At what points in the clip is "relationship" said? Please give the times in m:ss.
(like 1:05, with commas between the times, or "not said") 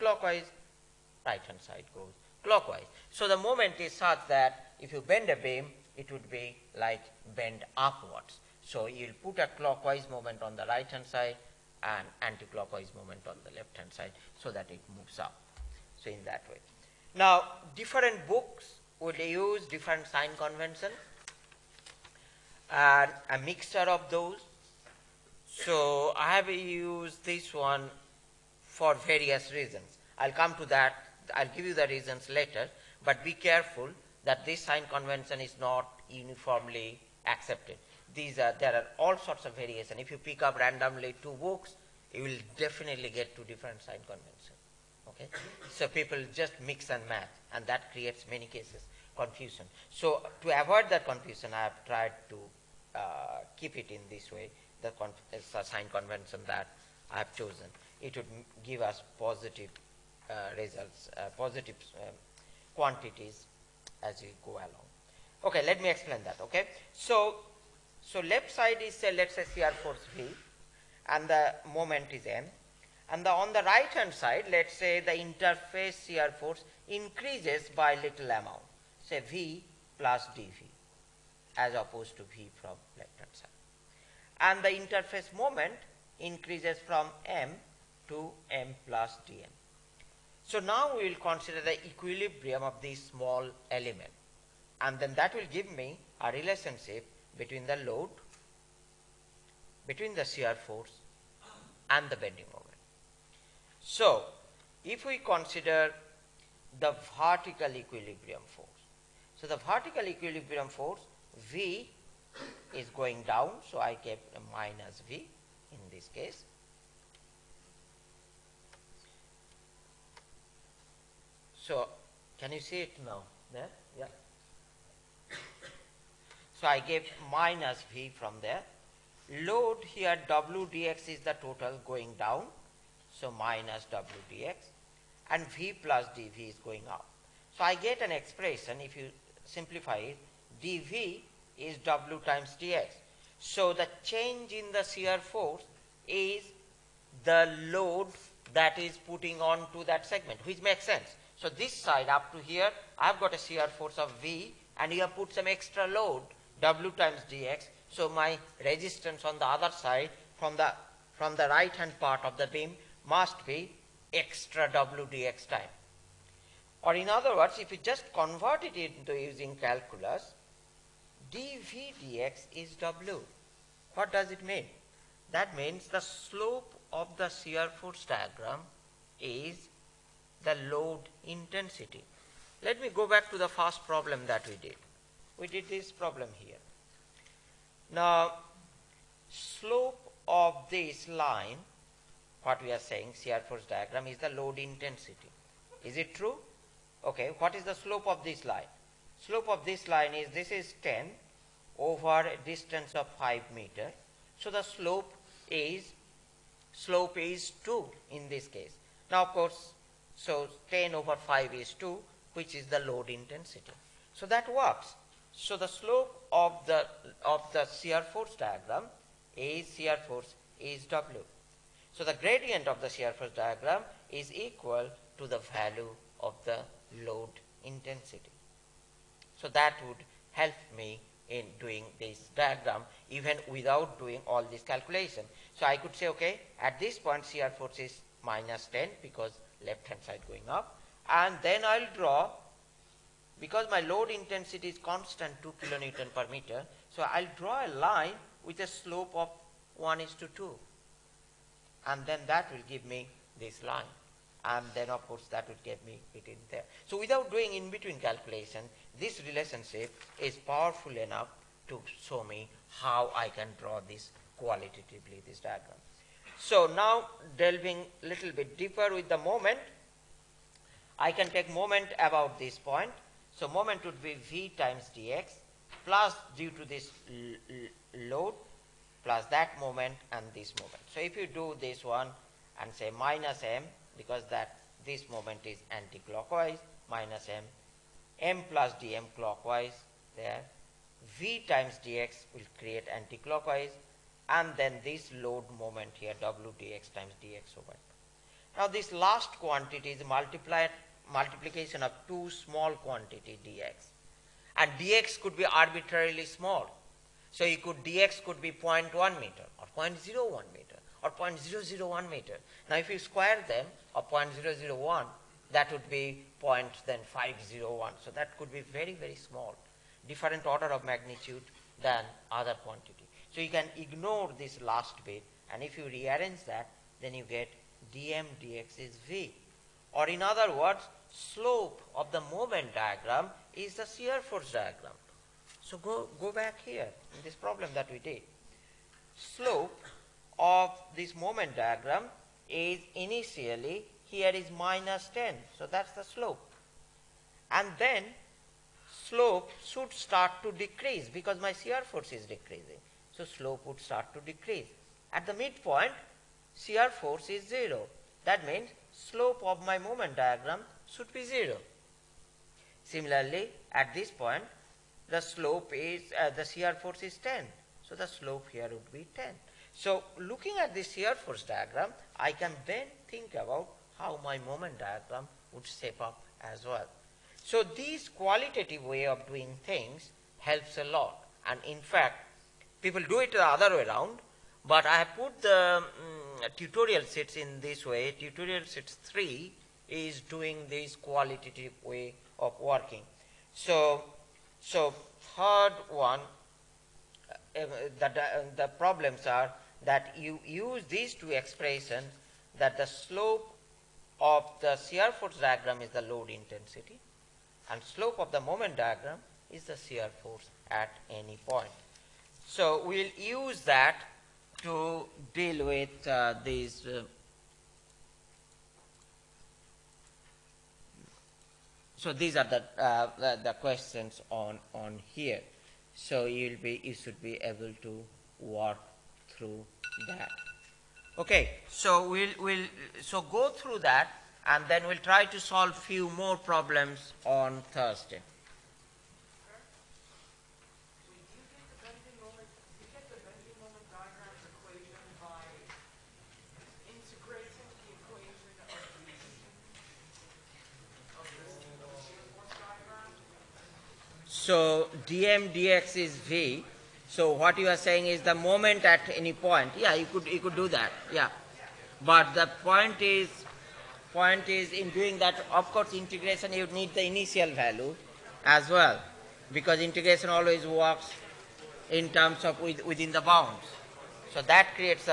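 1:36, 4:19.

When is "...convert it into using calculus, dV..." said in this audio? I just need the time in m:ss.
2:48.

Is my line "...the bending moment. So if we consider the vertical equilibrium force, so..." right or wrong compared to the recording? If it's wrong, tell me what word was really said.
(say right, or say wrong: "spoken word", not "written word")
right.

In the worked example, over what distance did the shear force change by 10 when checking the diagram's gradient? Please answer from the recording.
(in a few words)
5 meters.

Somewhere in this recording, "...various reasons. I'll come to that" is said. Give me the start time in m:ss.
0:28.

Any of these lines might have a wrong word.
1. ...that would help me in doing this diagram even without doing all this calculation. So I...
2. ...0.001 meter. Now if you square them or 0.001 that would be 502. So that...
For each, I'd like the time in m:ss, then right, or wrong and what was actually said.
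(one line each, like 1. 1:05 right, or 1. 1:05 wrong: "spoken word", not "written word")
1. 3:49 right
2. 5:11 wrong: "501", not "502".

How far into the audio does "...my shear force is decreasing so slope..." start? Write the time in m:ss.
5:51.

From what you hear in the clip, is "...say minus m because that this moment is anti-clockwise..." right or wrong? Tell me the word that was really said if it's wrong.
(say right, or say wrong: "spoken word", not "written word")
right.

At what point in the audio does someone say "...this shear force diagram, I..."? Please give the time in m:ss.
6:10.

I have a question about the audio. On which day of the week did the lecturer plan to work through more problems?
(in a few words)
Thursday.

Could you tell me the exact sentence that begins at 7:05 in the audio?
So you'll be, you should be able to work through that.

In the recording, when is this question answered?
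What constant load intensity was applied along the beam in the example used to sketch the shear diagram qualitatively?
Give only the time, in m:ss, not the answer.
4:05.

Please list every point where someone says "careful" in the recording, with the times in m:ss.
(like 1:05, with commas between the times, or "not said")
0:33.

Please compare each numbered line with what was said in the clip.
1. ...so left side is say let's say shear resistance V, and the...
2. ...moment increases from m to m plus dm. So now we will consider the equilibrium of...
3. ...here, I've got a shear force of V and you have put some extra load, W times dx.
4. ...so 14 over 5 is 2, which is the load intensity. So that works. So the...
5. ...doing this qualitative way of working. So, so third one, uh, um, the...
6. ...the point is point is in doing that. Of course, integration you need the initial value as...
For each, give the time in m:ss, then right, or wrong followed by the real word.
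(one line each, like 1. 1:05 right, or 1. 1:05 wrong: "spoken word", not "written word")
1. 1:08 wrong: "force", not "resistance"
2. 1:25 right
3. 2:32 right
4. 3:30 wrong: "10", not "14"
5. 6:30 right
6. 7:42 right.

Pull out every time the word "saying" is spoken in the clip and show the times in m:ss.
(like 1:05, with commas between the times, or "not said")
3:12, 7:37.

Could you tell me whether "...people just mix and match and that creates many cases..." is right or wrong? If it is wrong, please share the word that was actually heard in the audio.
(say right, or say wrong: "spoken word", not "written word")
right.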